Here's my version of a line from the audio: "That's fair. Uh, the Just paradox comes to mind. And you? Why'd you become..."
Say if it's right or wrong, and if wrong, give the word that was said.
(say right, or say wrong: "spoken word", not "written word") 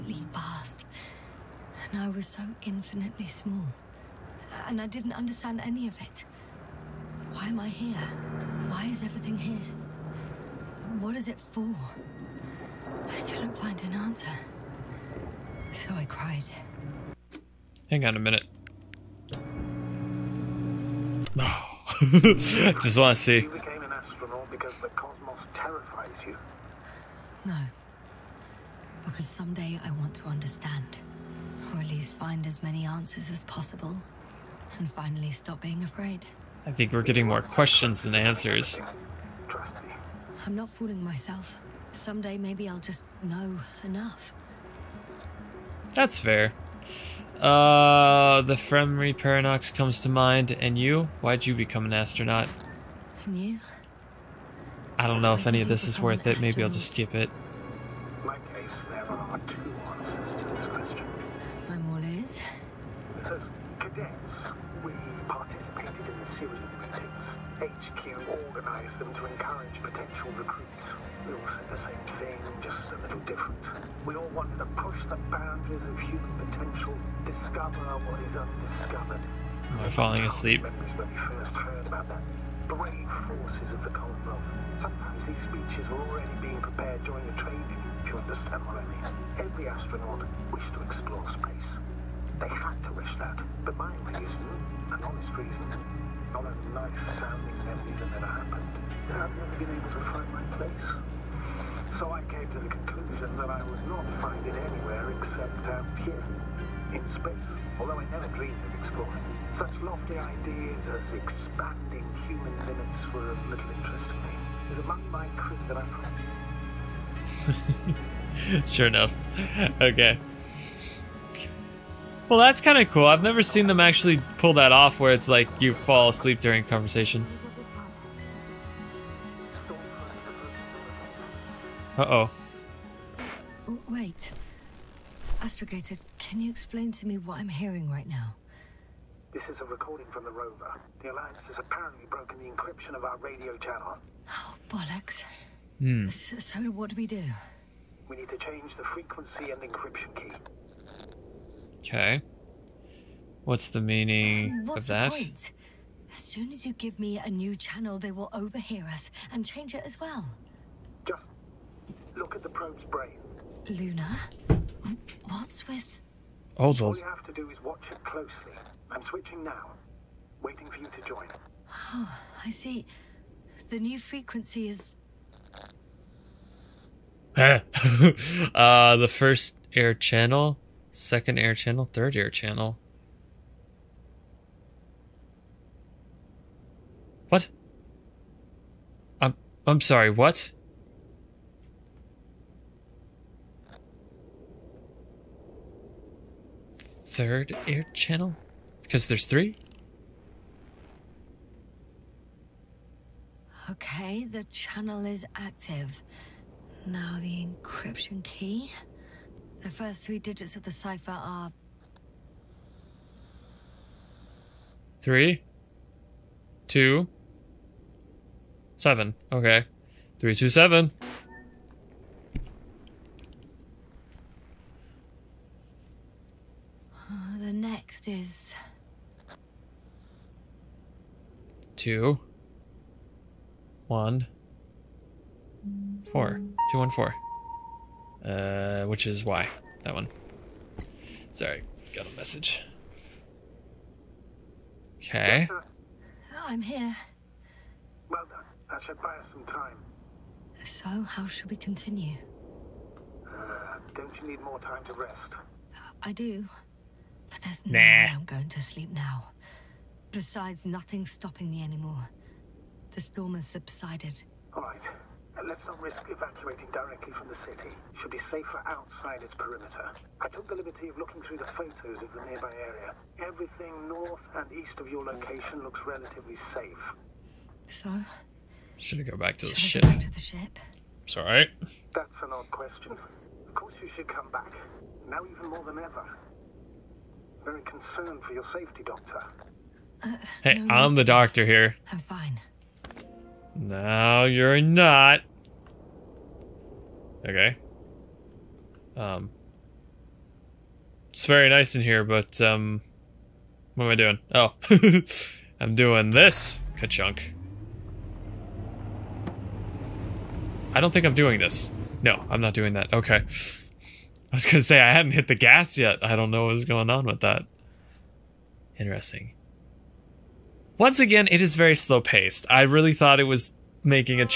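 wrong: "Fermi", not "Just".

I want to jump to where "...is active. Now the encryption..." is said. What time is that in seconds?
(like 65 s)
205 s.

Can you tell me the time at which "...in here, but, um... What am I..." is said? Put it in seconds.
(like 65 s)
301 s.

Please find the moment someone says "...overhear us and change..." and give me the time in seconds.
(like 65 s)
158 s.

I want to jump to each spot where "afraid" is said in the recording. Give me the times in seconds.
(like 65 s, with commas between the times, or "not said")
35 s.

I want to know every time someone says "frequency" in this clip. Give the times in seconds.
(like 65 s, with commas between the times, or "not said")
148 s, 173 s.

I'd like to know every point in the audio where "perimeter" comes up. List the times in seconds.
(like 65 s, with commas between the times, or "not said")
269 s.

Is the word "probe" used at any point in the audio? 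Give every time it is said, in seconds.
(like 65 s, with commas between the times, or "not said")
162 s.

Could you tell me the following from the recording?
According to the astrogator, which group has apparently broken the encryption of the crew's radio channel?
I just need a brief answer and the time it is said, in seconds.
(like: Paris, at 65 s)
The Alliance, at 141 s.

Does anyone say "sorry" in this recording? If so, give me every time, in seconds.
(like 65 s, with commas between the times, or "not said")
189 s, 241 s.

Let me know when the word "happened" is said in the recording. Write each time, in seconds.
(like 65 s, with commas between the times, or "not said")
98 s.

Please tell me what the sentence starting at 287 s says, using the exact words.
Very concerned for your safety, Doctor.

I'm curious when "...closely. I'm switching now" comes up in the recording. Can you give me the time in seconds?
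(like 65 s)
168 s.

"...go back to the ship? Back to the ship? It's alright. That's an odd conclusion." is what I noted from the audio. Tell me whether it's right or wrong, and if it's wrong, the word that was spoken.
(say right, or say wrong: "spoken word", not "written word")
wrong: "question", not "conclusion".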